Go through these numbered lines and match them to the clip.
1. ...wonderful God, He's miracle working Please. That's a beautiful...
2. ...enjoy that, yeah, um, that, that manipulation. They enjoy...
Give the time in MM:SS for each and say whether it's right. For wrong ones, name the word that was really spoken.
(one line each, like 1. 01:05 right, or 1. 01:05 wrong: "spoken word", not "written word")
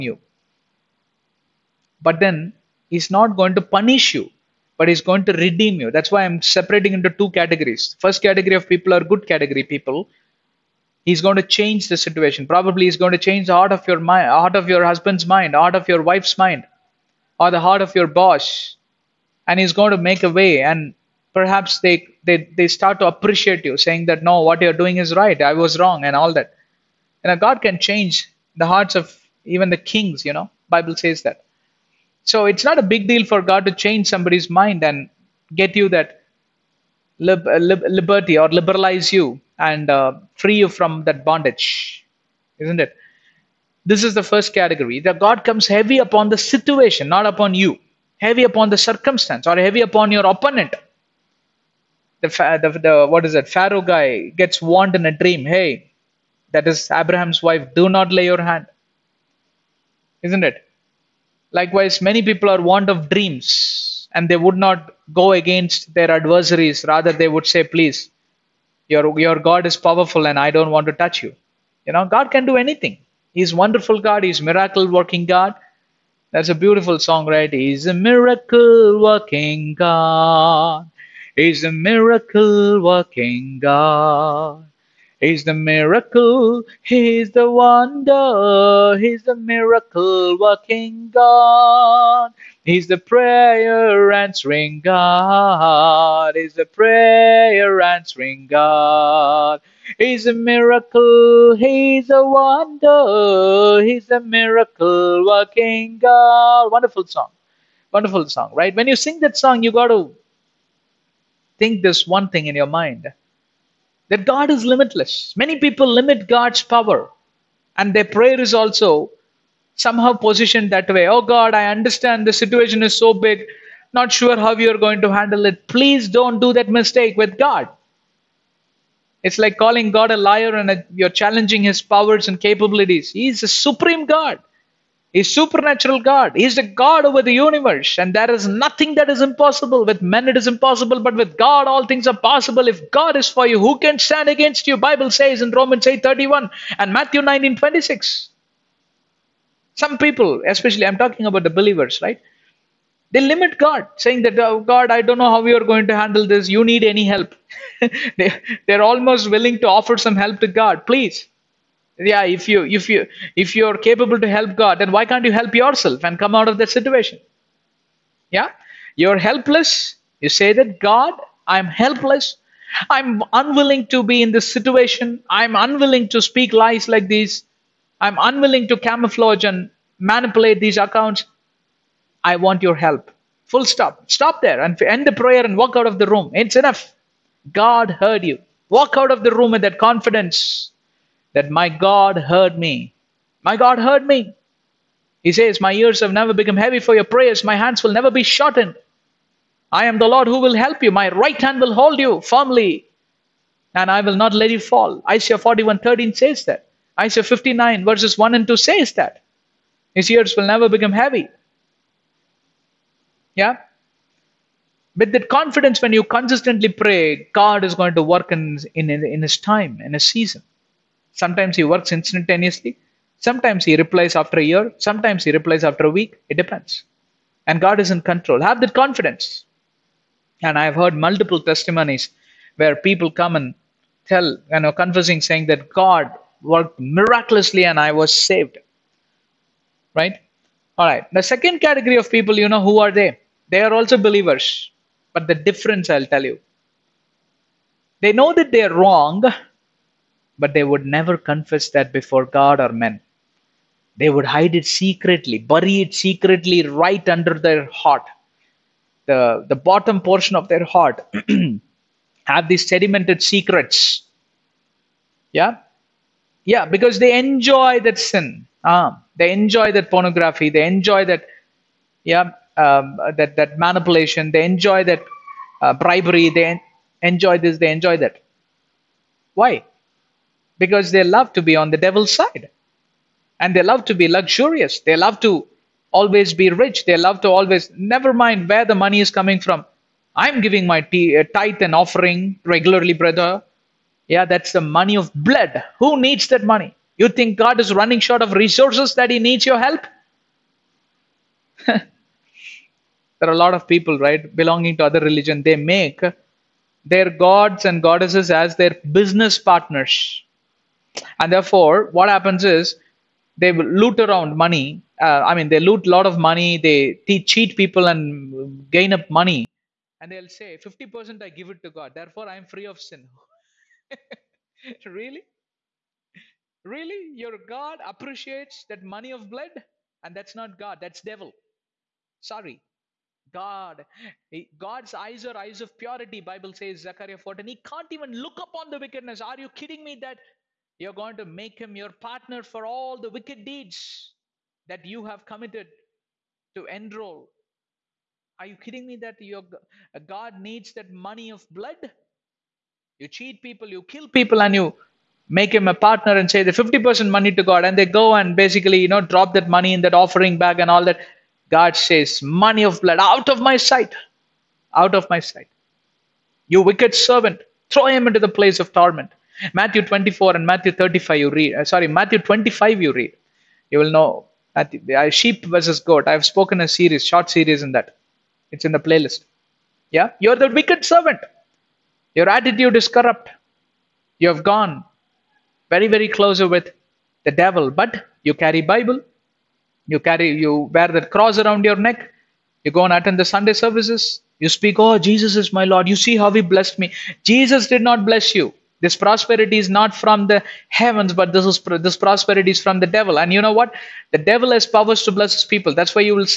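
1. 01:13 wrong: "God", not "Please"
2. 04:30 right.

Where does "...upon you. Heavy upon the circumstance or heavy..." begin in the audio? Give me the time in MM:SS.
00:47.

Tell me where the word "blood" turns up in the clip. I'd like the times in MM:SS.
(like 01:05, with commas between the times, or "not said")
04:55, 05:29, 05:51, 06:02.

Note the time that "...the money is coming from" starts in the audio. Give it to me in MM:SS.
04:48.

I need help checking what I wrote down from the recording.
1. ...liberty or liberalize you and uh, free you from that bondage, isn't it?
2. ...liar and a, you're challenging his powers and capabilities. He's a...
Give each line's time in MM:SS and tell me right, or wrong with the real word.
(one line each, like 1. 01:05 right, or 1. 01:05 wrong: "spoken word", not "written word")
1. 00:37 right
2. 02:10 right.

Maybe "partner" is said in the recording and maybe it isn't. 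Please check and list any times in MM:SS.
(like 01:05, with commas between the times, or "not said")
05:09, 05:41, 05:55.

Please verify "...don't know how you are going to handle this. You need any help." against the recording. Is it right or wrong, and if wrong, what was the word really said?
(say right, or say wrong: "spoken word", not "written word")
right.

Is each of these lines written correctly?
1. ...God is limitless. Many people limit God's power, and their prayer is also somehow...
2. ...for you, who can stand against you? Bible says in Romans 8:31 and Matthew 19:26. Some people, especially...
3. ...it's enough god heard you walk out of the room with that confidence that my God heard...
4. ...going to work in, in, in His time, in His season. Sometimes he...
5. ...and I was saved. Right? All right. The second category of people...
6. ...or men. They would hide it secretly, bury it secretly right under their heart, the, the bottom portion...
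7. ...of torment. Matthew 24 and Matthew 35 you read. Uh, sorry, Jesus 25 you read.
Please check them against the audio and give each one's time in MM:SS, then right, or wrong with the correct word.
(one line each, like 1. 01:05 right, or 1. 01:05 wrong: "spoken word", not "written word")
1. 01:54 right
2. 02:23 right
3. 03:06 right
4. 03:37 right
5. 03:57 right
6. 04:12 right
7. 06:08 wrong: "Matthew", not "Jesus".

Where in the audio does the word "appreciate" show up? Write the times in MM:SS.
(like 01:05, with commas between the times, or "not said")
00:23, 05:27.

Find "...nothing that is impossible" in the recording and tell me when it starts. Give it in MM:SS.
02:18.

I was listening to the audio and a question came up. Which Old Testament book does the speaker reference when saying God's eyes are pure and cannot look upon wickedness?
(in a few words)
Zechariah.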